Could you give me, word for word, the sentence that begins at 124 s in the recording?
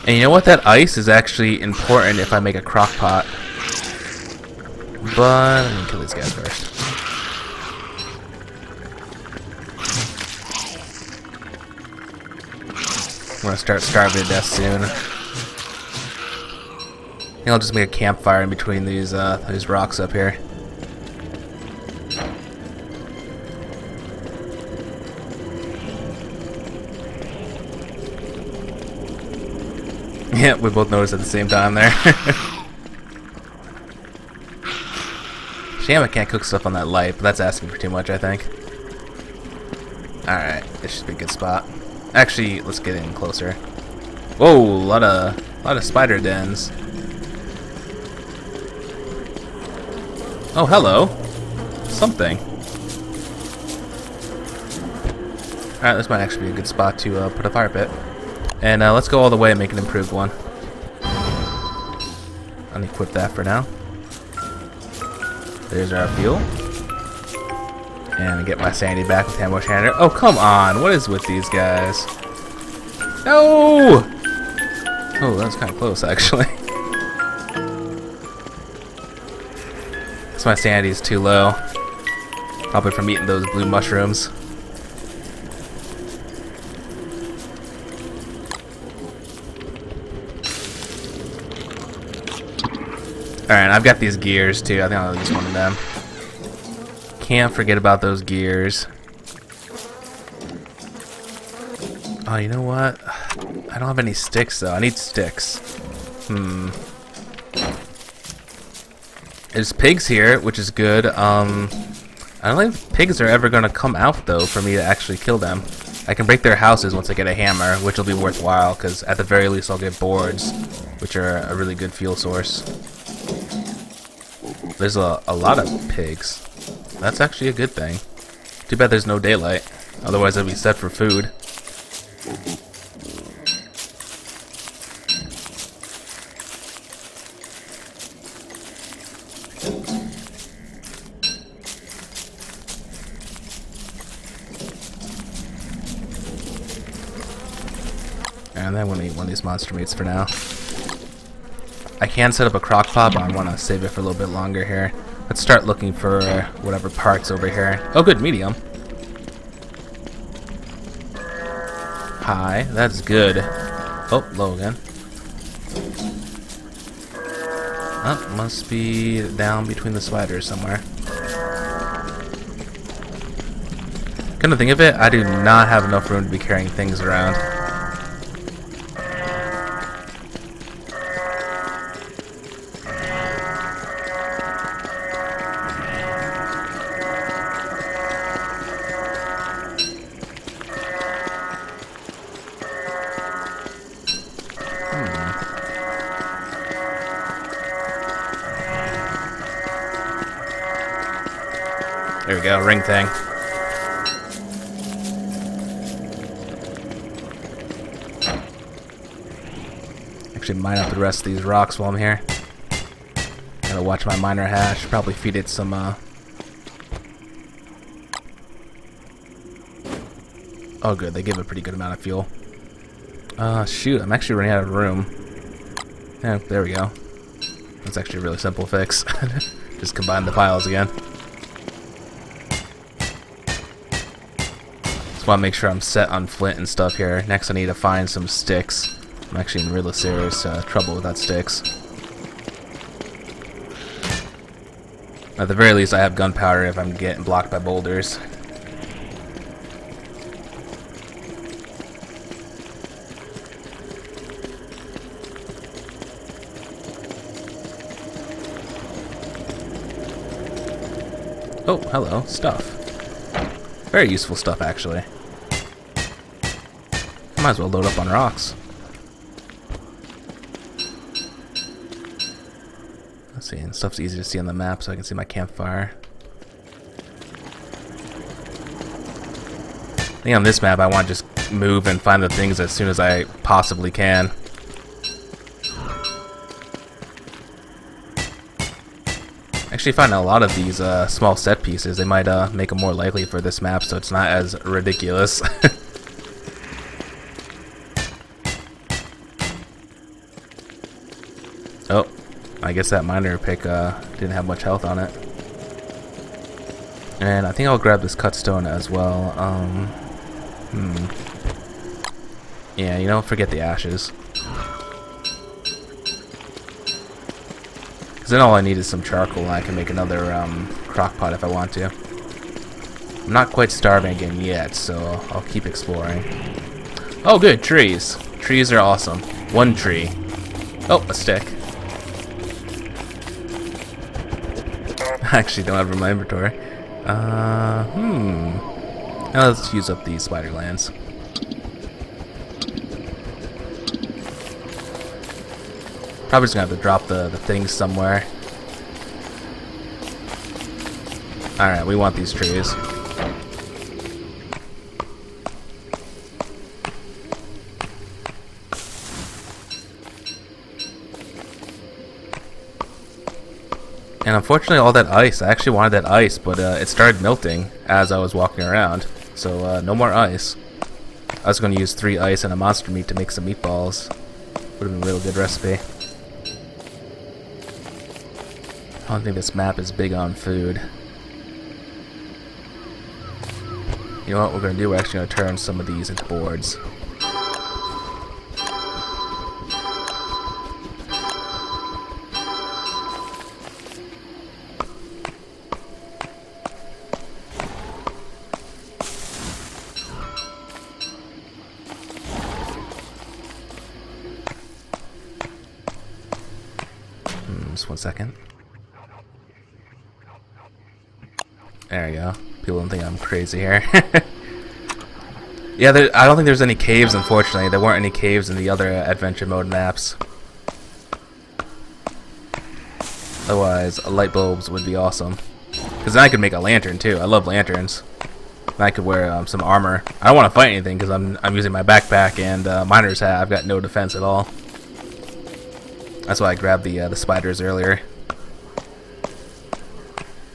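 There's a, a lot of pigs.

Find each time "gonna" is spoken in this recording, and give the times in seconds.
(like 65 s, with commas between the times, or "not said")
13 s, 346 s.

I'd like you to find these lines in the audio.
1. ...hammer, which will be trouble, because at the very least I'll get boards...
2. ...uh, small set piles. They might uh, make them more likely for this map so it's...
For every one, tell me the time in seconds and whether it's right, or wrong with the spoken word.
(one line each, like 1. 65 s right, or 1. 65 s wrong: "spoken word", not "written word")
1. 117 s wrong: "worthwhile", not "trouble"
2. 290 s wrong: "pieces", not "piles".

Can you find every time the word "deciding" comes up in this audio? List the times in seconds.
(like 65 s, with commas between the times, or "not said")
not said.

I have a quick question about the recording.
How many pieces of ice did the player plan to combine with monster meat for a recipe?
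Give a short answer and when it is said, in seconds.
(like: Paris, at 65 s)
3, at 371 s.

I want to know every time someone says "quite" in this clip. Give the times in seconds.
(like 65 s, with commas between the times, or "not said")
323 s.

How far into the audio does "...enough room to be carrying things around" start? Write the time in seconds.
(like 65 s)
175 s.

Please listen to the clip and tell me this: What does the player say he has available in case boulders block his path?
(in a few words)
Gunpowder.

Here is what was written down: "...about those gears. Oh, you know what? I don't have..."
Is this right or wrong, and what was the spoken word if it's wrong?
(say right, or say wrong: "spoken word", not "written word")
right.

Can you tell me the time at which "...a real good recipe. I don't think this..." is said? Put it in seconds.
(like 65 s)
375 s.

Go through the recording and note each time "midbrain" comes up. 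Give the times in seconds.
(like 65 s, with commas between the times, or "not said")
not said.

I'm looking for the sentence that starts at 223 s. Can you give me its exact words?
Uh, shoot, I'm actually running out of room.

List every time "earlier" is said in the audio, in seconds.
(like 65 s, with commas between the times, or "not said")
437 s.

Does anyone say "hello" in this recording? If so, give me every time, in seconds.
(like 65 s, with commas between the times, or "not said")
50 s, 261 s.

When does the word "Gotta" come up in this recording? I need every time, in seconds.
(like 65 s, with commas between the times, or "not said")
213 s.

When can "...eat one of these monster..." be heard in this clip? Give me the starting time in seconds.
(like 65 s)
149 s.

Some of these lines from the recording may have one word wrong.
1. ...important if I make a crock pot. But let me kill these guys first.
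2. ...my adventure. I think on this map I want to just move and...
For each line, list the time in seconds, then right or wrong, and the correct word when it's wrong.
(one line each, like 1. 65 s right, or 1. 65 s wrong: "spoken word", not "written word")
1. 1 s right
2. 275 s wrong: "campfire", not "adventure".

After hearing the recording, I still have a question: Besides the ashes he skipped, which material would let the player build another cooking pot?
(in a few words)
Charcoal.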